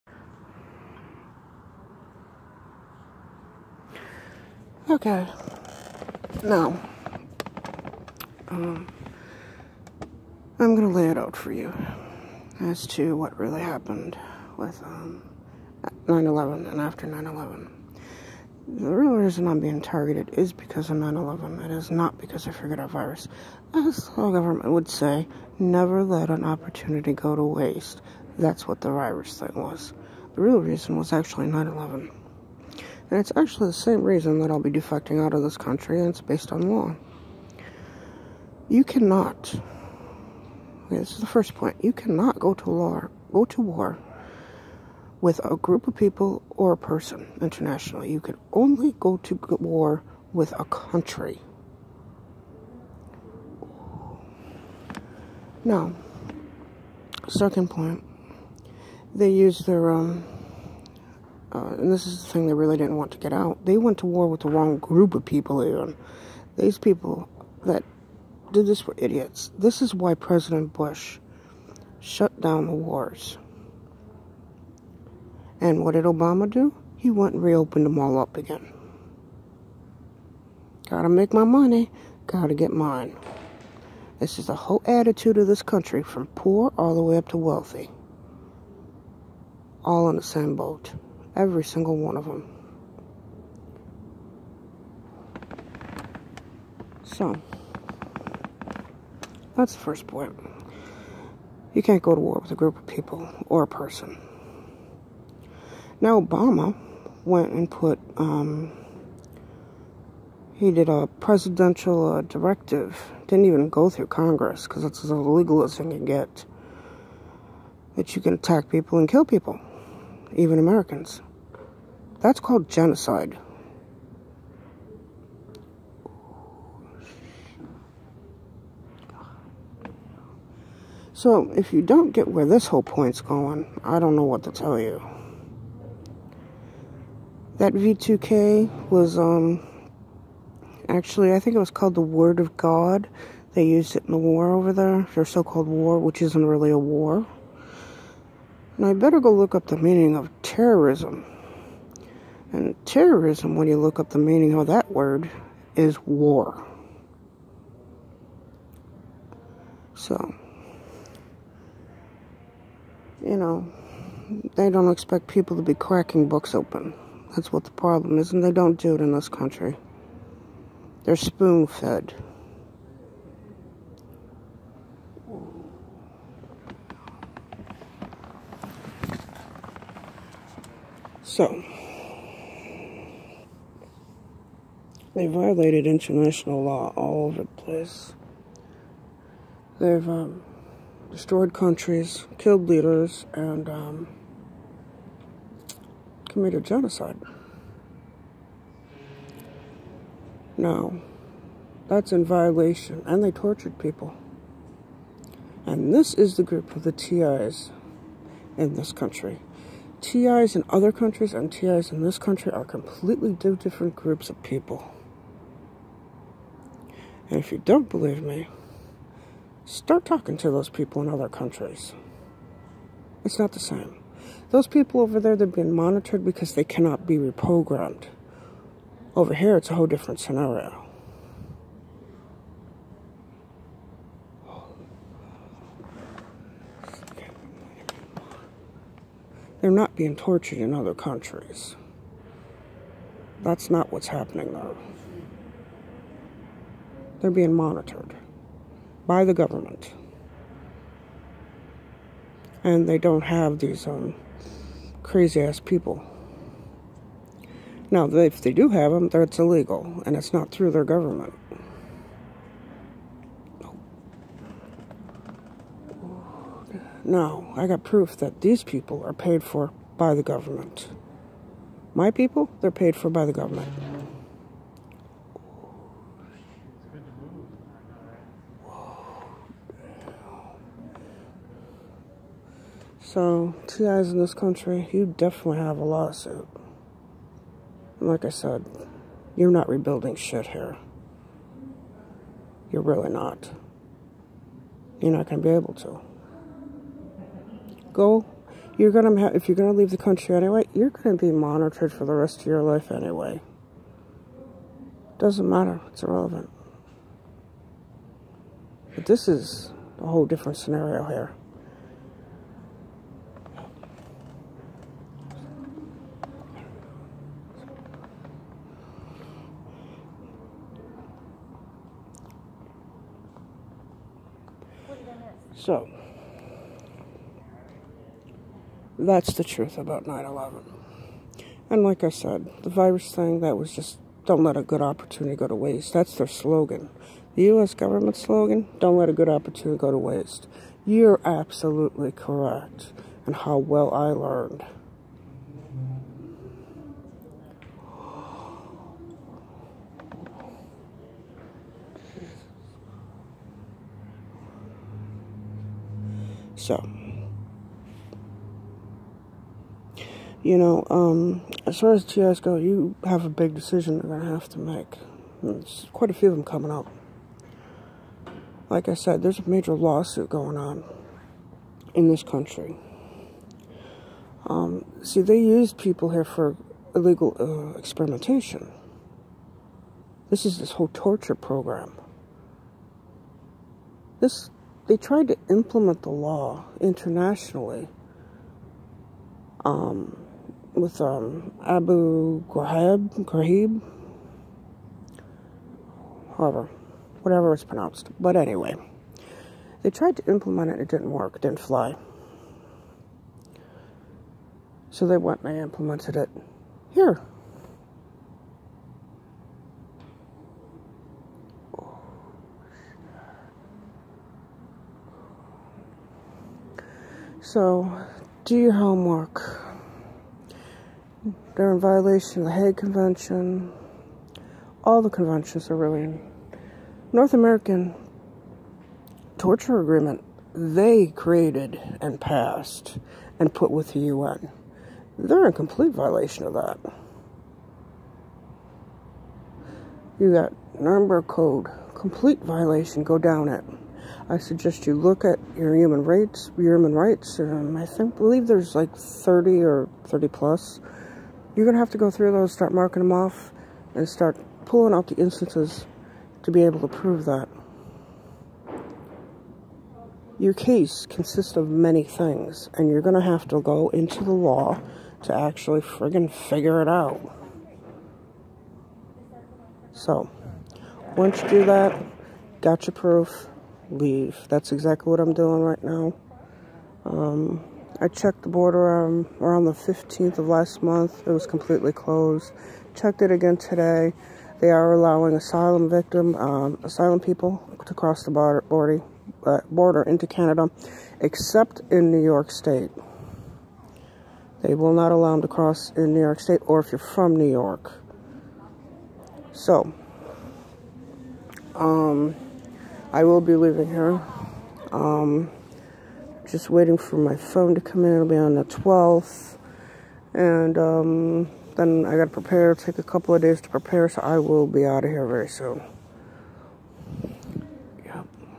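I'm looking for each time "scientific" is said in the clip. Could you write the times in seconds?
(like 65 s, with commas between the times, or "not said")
not said.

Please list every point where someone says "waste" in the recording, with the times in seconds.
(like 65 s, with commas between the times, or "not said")
27 s, 335 s, 339 s.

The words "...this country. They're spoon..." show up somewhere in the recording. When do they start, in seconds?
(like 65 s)
169 s.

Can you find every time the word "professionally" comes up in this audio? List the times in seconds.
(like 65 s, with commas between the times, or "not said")
not said.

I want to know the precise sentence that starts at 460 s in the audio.
Your case consists of many things, and you're going to have to go into the law to actually friggin' figure it out.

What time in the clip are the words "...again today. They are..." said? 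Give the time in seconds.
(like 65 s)
483 s.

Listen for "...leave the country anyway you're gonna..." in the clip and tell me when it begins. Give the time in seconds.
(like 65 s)
299 s.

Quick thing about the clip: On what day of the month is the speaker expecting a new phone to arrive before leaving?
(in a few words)
12th.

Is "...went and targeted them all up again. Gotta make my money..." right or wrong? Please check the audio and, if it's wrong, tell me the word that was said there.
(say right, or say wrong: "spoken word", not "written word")
wrong: "reopened", not "targeted".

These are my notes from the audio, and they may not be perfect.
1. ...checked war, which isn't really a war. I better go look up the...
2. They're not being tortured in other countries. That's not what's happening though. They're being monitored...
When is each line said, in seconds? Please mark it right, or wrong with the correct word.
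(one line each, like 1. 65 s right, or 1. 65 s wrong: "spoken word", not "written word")
1. 145 s wrong: "called", not "checked"
2. 239 s right.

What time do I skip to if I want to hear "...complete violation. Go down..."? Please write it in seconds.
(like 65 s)
441 s.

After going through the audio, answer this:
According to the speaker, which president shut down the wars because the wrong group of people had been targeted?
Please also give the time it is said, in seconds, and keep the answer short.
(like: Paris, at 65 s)
President Bush, at 70 s.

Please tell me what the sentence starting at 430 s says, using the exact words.
They created and passed and put with the UN.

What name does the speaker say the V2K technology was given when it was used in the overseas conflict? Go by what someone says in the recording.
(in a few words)
Word of God.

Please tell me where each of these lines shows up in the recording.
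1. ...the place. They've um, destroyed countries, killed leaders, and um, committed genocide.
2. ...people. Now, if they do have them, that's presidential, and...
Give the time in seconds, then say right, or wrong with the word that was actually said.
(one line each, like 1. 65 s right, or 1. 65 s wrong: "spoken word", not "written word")
1. 187 s right
2. 255 s wrong: "illegal", not "presidential".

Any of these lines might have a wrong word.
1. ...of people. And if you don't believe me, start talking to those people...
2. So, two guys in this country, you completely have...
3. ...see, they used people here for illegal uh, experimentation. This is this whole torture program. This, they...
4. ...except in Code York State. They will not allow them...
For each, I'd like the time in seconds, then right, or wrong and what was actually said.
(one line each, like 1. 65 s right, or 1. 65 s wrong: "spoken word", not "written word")
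1. 214 s right
2. 283 s wrong: "definitely", not "completely"
3. 375 s right
4. 491 s wrong: "New", not "Code".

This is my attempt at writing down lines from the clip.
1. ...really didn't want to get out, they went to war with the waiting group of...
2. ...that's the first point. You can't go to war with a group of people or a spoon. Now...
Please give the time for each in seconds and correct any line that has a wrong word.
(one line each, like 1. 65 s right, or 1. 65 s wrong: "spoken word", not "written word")
1. 62 s wrong: "wrong", not "waiting"
2. 99 s wrong: "person", not "spoon".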